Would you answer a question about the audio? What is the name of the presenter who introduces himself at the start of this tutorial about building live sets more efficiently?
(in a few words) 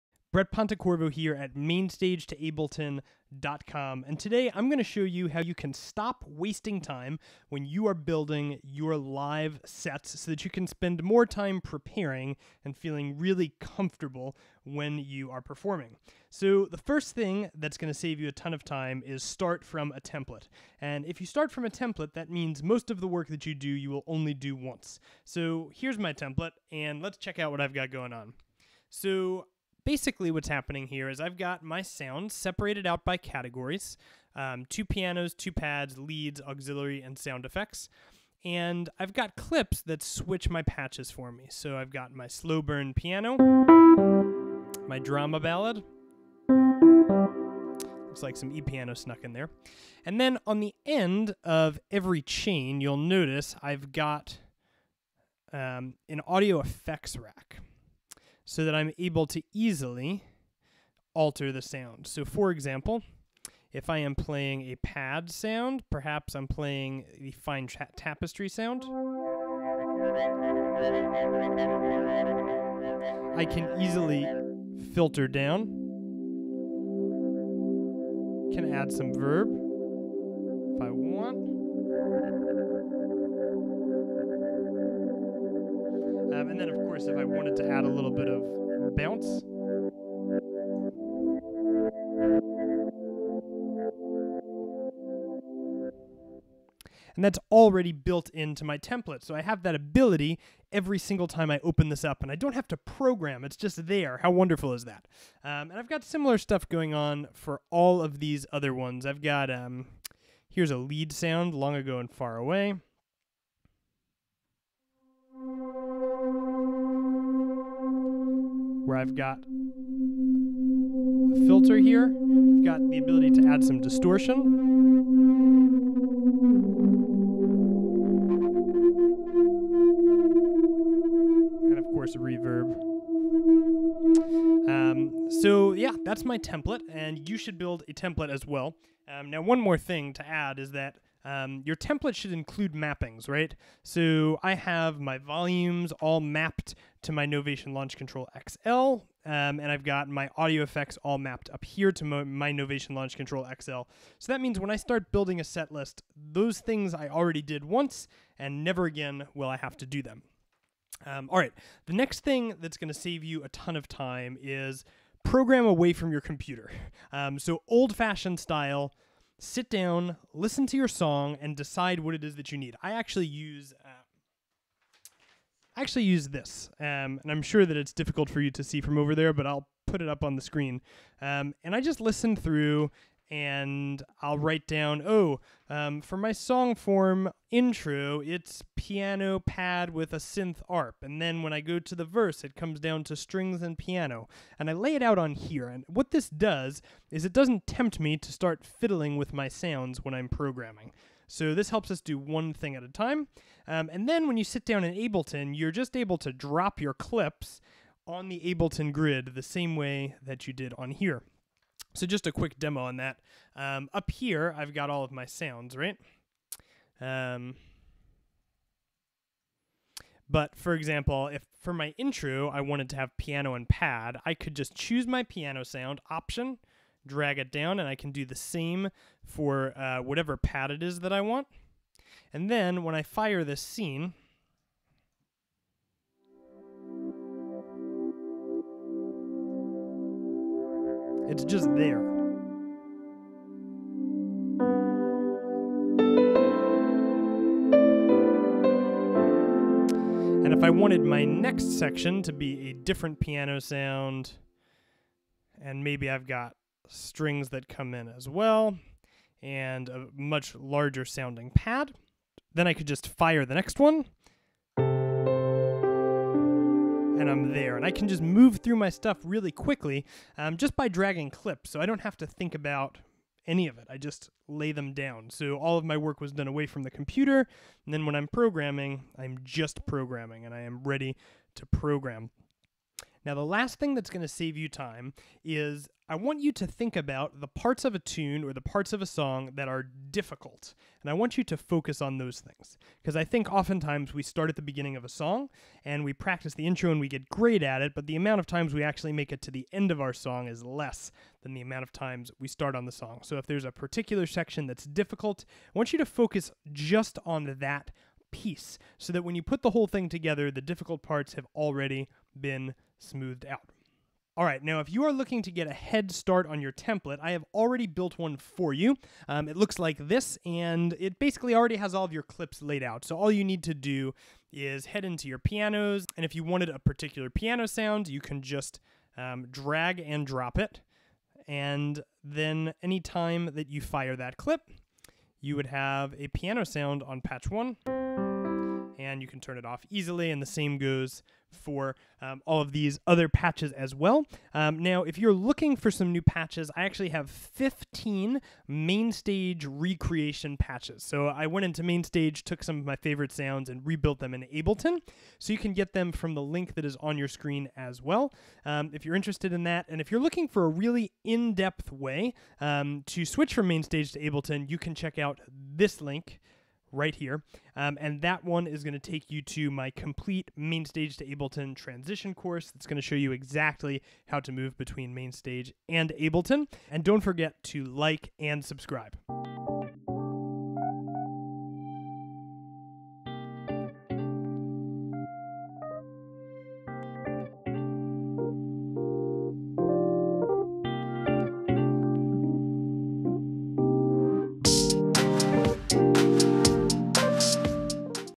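Brett Pontecorvo.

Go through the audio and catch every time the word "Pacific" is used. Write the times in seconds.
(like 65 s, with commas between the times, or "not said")
not said.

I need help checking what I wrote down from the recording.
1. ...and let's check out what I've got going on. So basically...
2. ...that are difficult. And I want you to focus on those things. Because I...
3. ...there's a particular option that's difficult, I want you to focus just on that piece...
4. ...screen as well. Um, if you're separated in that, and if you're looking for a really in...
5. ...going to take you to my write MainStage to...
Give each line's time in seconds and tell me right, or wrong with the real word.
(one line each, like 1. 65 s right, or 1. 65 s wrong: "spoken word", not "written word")
1. 26 s right
2. 289 s right
3. 303 s wrong: "section", not "option"
4. 357 s wrong: "interested", not "separated"
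5. 368 s wrong: "complete", not "write".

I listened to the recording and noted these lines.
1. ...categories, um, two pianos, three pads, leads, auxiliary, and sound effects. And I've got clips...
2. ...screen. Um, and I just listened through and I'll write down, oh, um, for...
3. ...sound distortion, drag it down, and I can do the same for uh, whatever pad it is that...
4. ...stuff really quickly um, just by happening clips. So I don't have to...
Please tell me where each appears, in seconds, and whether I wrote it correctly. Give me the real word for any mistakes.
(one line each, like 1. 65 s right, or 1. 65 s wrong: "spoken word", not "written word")
1. 33 s wrong: "two", not "three"
2. 180 s right
3. 225 s wrong: "option", not "distortion"
4. 268 s wrong: "dragging", not "happening".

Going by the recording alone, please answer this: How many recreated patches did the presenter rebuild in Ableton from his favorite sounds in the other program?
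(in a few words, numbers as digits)
15.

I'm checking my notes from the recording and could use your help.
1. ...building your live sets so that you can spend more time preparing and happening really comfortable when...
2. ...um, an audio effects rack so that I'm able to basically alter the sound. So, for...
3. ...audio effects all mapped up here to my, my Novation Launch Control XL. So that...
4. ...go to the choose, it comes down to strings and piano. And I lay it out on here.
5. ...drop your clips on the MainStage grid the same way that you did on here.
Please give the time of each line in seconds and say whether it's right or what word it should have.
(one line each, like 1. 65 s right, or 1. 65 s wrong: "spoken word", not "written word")
1. 7 s wrong: "feeling", not "happening"
2. 55 s wrong: "easily", not "basically"
3. 150 s right
4. 191 s wrong: "verse", not "choose"
5. 206 s wrong: "Ableton", not "MainStage".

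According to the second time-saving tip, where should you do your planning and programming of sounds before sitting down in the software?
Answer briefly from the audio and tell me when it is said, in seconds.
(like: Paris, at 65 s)
Away from your computer, at 165 s.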